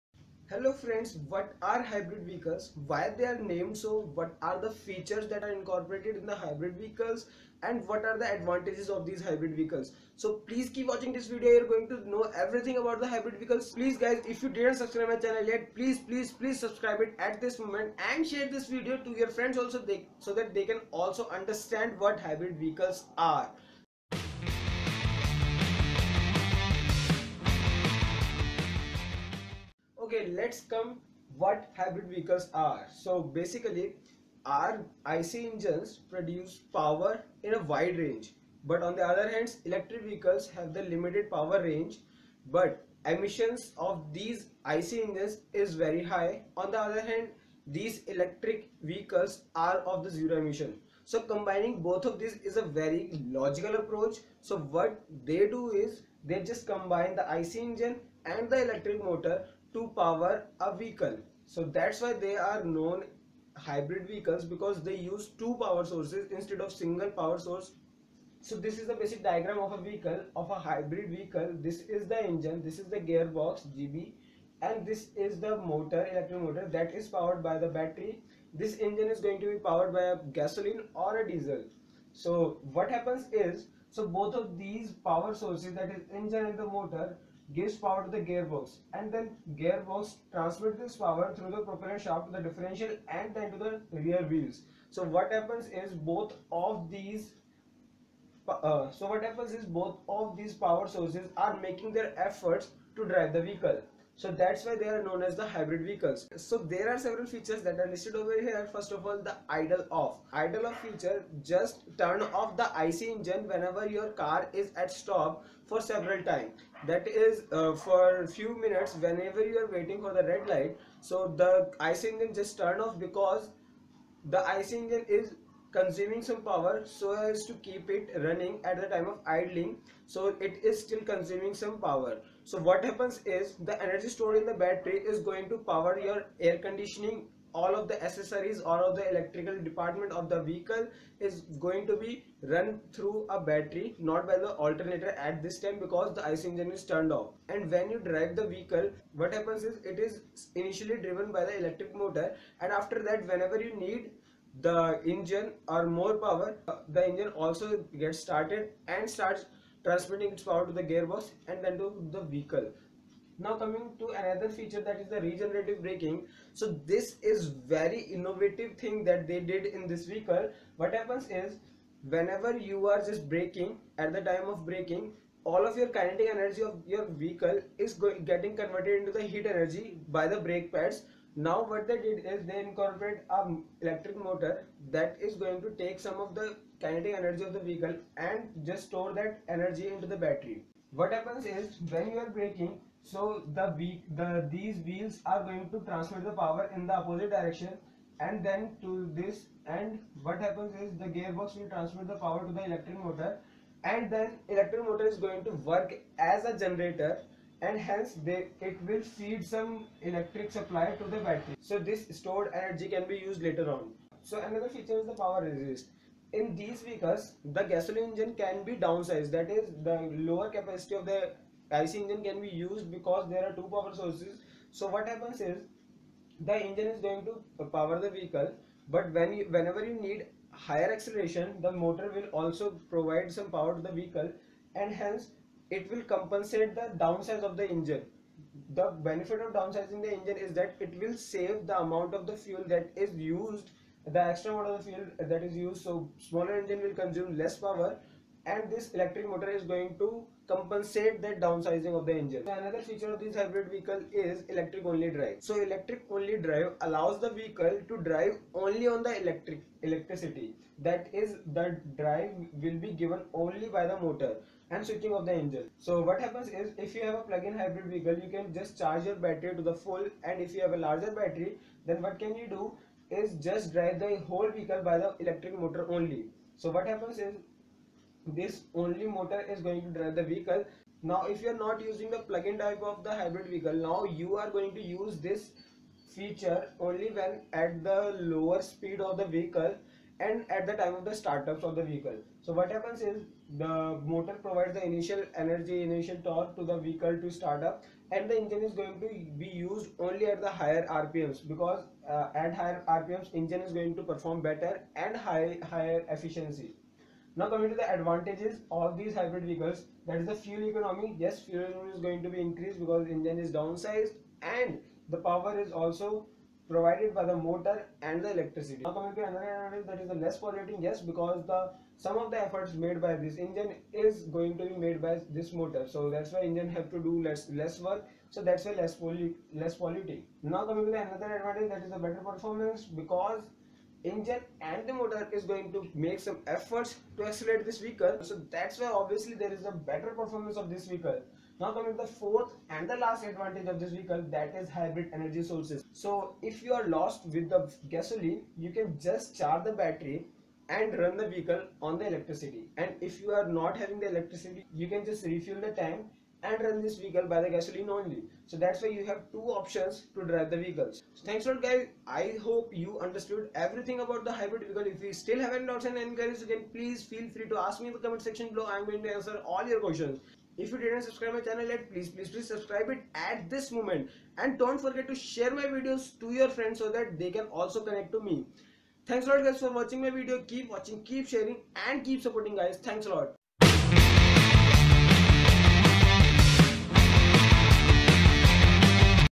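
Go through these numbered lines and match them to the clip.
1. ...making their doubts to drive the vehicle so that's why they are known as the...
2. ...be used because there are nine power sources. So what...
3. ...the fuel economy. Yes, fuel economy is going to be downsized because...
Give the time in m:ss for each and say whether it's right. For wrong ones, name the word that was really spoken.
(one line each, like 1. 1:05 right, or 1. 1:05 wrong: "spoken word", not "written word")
1. 1:41 wrong: "efforts", not "doubts"
2. 3:42 wrong: "two", not "nine"
3. 5:10 wrong: "increased", not "downsized".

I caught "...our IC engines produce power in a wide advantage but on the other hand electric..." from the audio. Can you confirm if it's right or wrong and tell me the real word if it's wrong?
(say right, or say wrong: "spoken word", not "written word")
wrong: "range", not "advantage".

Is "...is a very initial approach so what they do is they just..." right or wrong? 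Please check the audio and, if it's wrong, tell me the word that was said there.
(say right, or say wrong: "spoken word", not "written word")
wrong: "logical", not "initial".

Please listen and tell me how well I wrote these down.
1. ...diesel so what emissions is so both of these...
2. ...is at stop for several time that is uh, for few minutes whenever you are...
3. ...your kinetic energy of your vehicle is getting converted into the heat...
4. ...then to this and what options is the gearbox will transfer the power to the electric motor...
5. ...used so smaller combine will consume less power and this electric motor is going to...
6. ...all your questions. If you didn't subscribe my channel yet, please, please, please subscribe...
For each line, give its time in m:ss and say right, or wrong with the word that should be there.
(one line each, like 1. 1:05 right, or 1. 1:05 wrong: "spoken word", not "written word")
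1. 1:21 wrong: "happens", not "emissions"
2. 1:54 right
3. 2:55 right
4. 3:18 wrong: "happens", not "options"
5. 4:05 wrong: "engine", not "combine"
6. 6:09 right.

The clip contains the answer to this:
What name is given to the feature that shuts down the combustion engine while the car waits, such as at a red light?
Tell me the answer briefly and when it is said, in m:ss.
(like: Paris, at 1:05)
idle off, at 1:50.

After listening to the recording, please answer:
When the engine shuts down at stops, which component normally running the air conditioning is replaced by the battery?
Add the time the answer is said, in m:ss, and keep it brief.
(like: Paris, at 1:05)
the alternator, at 2:24.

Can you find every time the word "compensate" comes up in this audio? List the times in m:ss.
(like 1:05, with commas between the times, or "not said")
3:56, 4:10.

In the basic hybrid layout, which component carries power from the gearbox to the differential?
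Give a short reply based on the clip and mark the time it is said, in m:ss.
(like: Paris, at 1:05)
propeller shaft, at 1:31.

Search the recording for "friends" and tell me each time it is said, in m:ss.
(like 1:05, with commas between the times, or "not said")
0:00, 0:19, 6:16.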